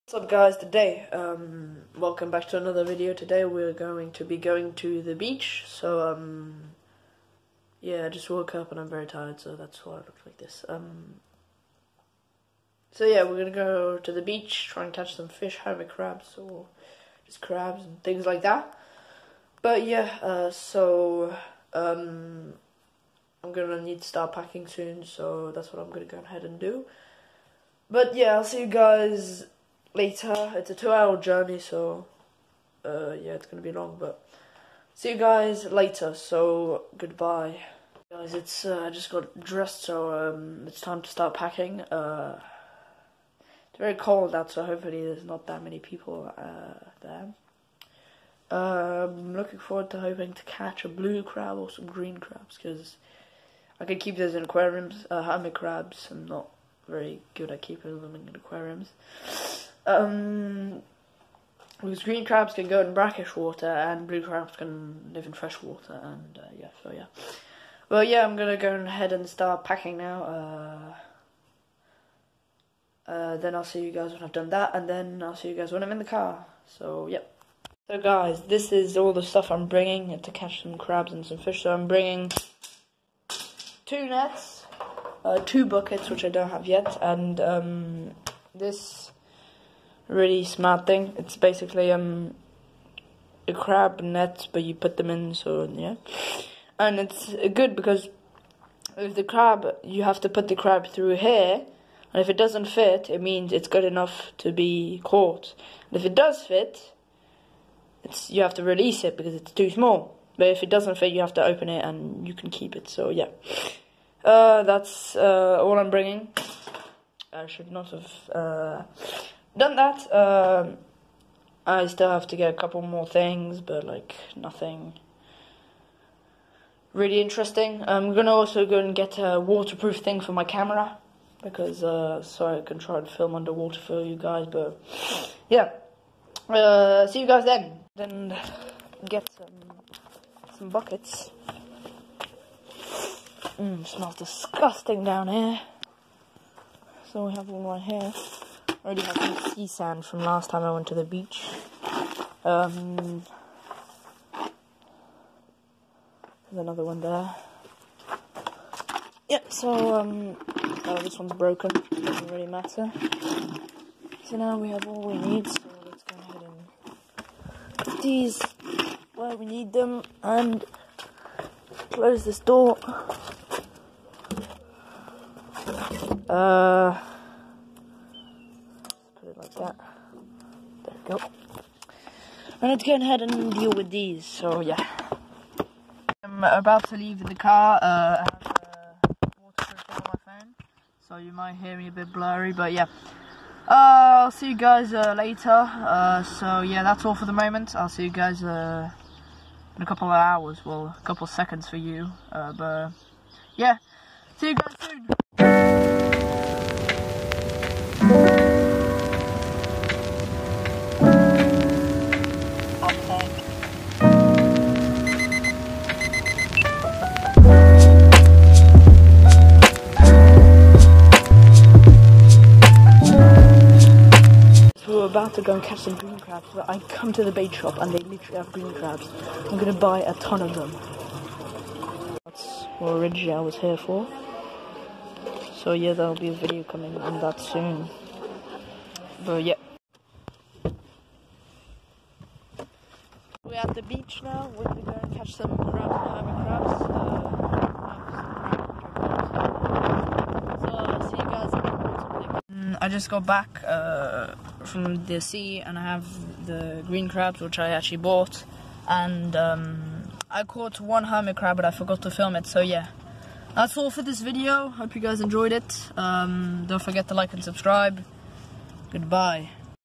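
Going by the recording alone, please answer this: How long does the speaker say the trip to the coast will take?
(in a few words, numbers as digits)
2 hours.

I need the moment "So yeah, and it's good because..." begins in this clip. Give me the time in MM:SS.
01:35.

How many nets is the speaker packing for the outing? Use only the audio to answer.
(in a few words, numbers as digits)
2.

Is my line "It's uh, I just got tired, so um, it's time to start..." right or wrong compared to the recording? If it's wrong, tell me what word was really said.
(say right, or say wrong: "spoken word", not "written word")
wrong: "dressed", not "tired".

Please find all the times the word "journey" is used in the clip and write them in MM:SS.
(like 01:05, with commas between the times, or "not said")
00:31.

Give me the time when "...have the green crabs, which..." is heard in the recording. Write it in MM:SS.
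04:15.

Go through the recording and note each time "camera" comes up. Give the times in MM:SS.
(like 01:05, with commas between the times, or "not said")
02:10.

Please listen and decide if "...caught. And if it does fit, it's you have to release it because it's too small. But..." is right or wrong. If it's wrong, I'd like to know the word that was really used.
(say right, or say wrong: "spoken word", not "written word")
right.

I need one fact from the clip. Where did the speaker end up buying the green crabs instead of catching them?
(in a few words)
The bait shop.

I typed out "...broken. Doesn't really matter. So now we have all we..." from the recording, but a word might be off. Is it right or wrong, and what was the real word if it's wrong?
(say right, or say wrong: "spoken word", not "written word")
right.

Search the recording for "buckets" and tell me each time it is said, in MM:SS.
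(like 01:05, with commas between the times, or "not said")
01:25, 02:20.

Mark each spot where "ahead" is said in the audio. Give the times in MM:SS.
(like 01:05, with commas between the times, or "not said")
00:26, 01:08, 02:46, 03:02.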